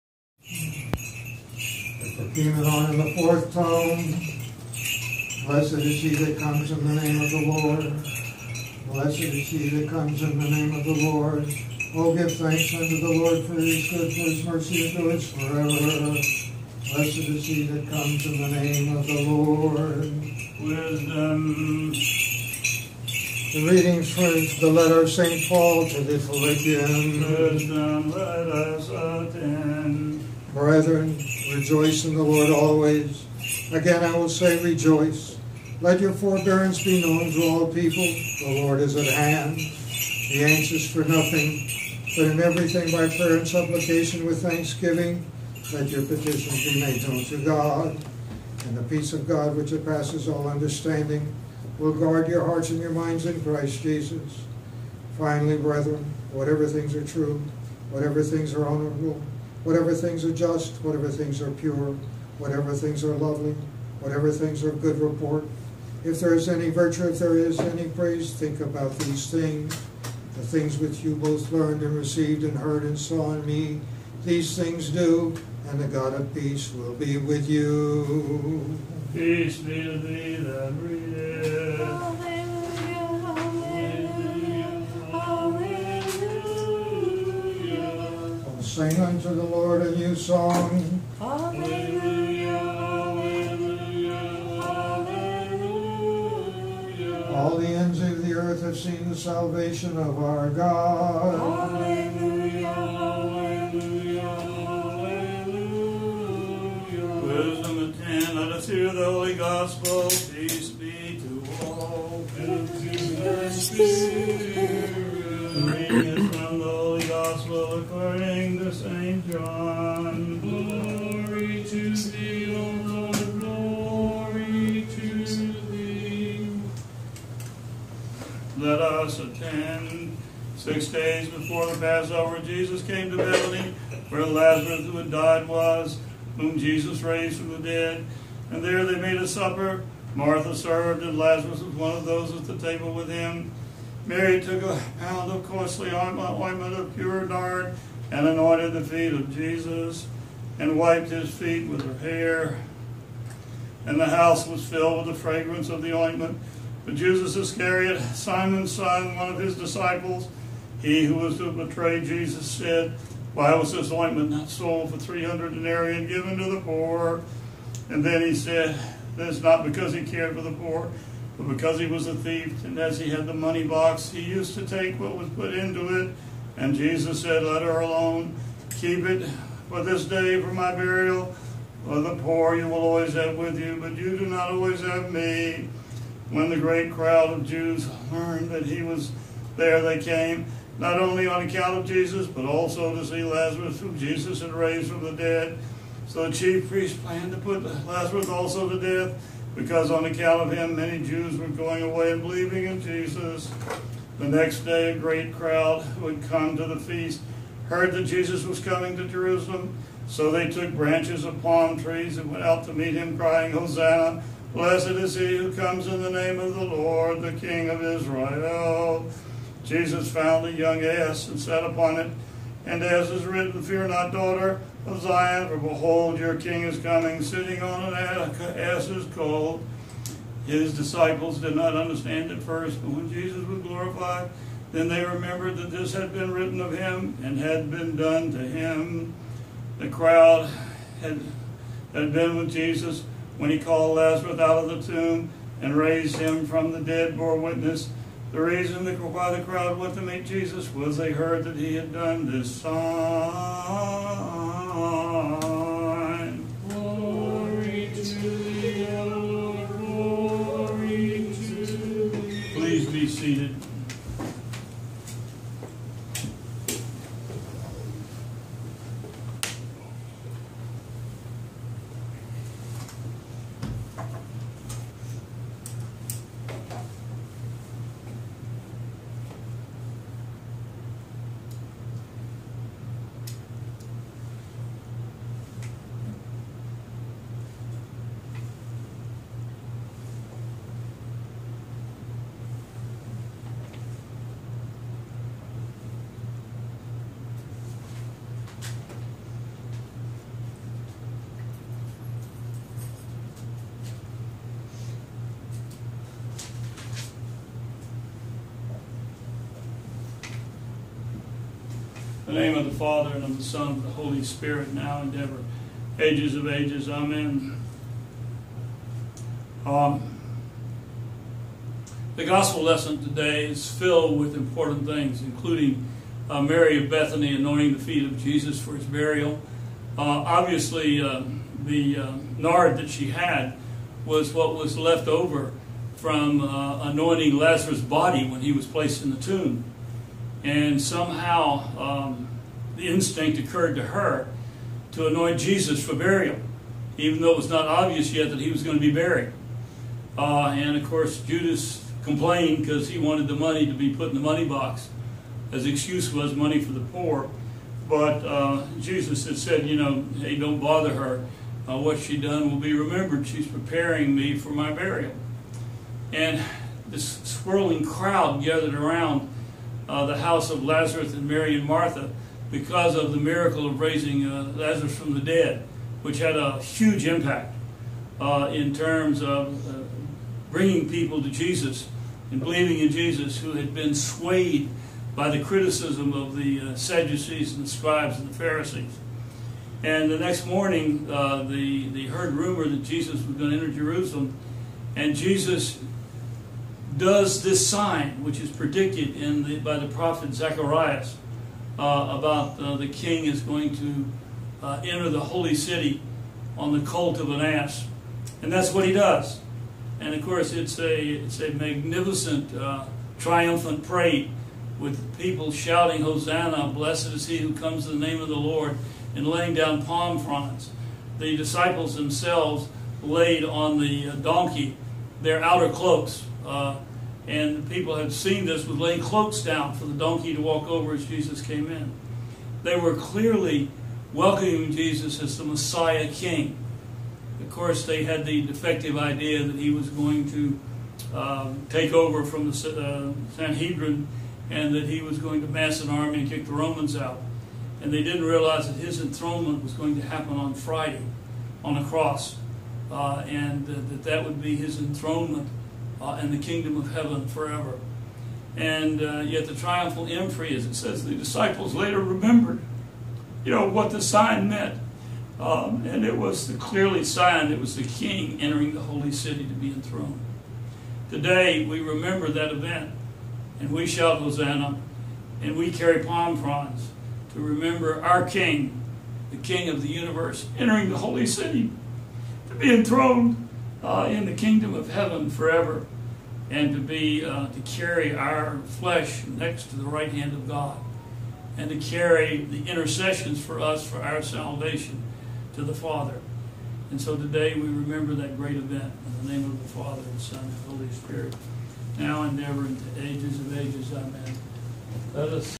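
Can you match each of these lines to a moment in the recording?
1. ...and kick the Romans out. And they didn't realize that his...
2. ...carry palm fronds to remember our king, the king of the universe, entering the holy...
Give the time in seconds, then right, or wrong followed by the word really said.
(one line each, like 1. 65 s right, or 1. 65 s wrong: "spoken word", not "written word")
1. 446 s right
2. 475 s right.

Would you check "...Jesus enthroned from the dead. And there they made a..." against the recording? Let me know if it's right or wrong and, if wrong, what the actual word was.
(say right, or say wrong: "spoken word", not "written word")
wrong: "raised", not "enthroned".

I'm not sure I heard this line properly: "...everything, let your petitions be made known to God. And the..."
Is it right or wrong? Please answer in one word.
wrong.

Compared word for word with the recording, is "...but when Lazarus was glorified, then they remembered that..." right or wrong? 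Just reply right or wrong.
wrong.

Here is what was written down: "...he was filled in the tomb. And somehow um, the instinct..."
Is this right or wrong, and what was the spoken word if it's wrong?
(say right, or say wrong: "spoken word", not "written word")
wrong: "placed", not "filled".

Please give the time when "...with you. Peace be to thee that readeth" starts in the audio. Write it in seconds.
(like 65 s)
77 s.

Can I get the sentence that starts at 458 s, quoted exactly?
And uh, yet the triumphal entry, as it says, the disciples later remembered, you know, what the sign meant.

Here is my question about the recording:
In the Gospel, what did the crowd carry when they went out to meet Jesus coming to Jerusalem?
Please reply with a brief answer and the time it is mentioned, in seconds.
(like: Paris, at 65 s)
branches of palm trees, at 210 s.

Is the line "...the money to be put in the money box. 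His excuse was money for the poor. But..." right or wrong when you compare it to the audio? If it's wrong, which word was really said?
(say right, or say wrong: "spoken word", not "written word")
right.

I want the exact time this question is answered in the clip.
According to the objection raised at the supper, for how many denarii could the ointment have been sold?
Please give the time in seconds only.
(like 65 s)
164 s.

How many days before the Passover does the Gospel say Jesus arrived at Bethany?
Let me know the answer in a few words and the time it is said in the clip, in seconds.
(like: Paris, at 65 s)
6, at 130 s.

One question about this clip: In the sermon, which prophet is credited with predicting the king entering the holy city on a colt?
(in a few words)
Zacharias.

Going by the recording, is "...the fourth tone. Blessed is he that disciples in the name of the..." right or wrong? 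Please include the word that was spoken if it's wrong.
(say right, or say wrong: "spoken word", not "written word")
wrong: "comes", not "disciples".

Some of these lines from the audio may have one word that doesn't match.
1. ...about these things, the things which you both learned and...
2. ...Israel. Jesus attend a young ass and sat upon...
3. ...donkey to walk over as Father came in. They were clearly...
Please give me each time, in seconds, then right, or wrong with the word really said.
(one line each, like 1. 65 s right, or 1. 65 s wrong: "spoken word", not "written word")
1. 68 s right
2. 217 s wrong: "found", not "attend"
3. 429 s wrong: "Jesus", not "Father".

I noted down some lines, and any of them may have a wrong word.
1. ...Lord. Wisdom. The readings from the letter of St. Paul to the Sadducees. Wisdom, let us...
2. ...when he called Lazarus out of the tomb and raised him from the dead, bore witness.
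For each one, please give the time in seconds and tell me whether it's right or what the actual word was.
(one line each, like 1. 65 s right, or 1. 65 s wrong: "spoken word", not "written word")
1. 19 s wrong: "Philippians", not "Sadducees"
2. 243 s right.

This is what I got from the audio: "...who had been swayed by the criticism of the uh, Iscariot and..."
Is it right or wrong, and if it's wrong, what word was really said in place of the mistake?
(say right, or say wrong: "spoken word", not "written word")
wrong: "Sadducees", not "Iscariot".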